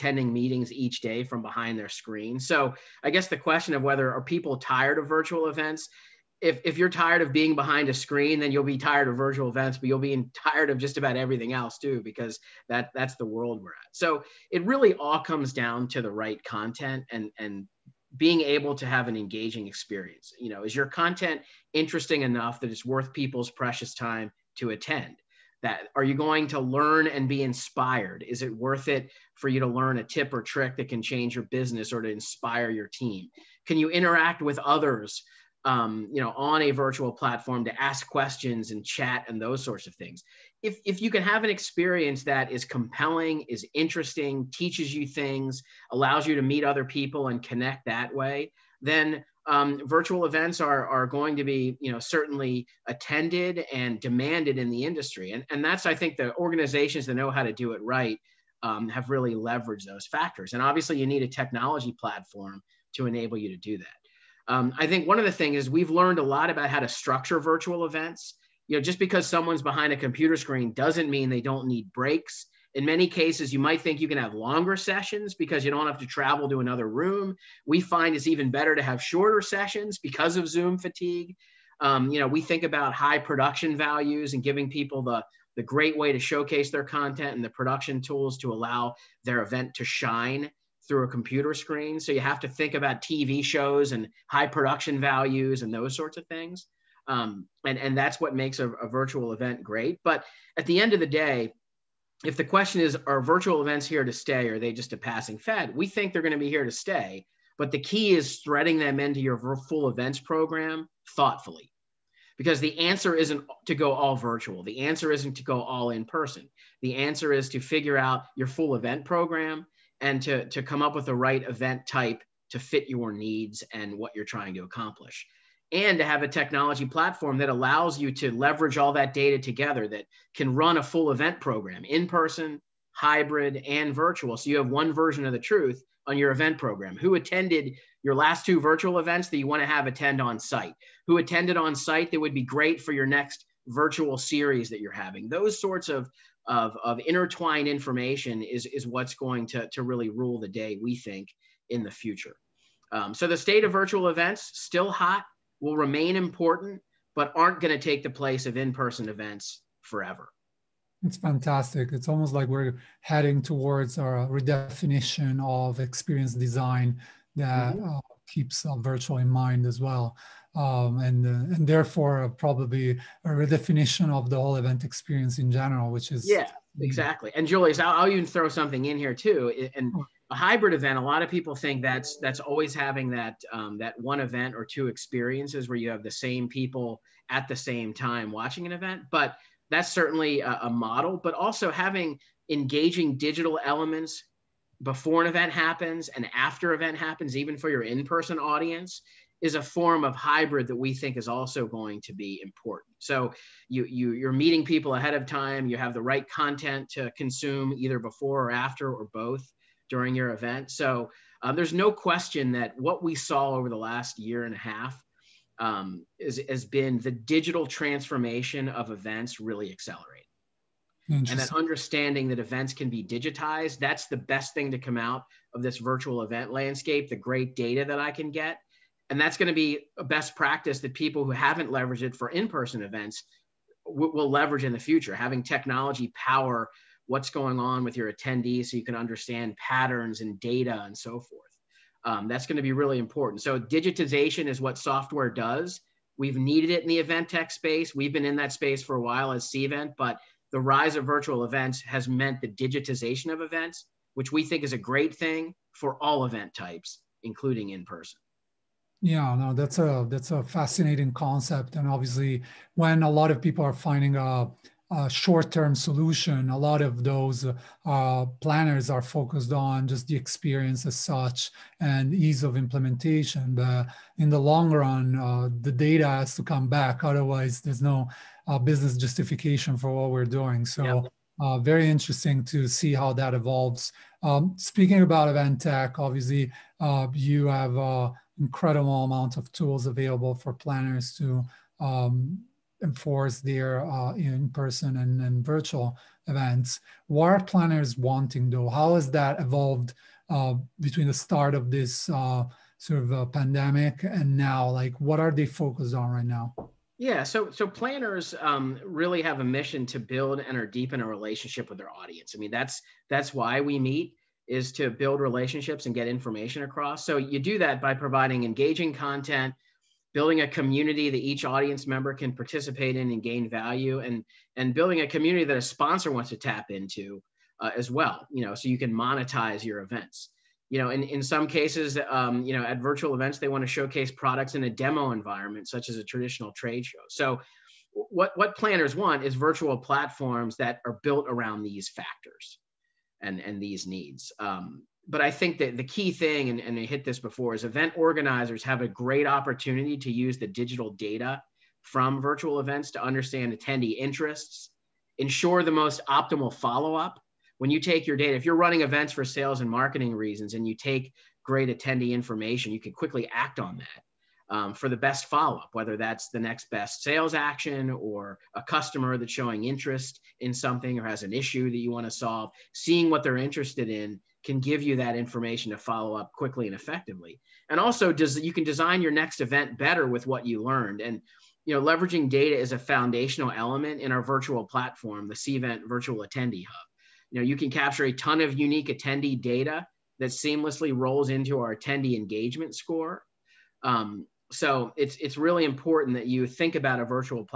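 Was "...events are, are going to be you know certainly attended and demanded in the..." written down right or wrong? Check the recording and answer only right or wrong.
right.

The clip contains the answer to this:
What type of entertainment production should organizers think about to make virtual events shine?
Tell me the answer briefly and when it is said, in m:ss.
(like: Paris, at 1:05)
TV shows, at 1:33.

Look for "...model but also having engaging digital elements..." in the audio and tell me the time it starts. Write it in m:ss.
3:10.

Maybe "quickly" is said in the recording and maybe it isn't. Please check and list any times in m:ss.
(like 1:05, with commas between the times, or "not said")
6:02, 6:16.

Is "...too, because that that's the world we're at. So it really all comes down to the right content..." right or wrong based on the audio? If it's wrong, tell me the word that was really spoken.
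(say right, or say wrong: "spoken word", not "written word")
right.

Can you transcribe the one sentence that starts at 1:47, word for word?
But the key is threading them into your full events program thoughtfully.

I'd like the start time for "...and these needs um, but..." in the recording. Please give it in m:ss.
5:43.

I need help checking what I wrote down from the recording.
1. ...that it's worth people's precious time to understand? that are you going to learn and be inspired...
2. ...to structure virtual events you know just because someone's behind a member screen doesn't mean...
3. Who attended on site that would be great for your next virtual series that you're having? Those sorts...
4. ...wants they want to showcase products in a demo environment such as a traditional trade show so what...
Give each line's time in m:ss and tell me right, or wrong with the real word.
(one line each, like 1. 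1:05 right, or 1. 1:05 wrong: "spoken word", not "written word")
1. 0:22 wrong: "attend", not "understand"
2. 1:06 wrong: "computer", not "member"
3. 2:21 right
4. 5:33 wrong: "events", not "wants".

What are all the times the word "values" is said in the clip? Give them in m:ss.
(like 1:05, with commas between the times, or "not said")
1:23, 1:34, 5:23.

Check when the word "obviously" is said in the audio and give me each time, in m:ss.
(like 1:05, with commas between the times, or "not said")
1:00, 4:21, 4:45.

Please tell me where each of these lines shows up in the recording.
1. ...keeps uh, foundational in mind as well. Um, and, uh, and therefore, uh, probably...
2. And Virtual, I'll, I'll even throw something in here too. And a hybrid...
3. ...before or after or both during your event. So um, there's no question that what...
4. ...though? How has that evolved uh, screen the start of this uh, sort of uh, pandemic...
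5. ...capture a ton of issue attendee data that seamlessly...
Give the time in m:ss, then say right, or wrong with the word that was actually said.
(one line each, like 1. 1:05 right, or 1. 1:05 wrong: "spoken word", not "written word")
1. 2:48 wrong: "virtual", not "foundational"
2. 2:57 wrong: "Julius", not "Virtual"
3. 3:27 right
4. 4:58 wrong: "between", not "screen"
5. 6:27 wrong: "unique", not "issue".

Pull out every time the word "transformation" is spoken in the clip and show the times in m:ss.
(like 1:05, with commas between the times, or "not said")
3:37.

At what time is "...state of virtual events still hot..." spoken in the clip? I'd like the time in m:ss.
2:33.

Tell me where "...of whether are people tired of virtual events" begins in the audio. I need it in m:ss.
0:03.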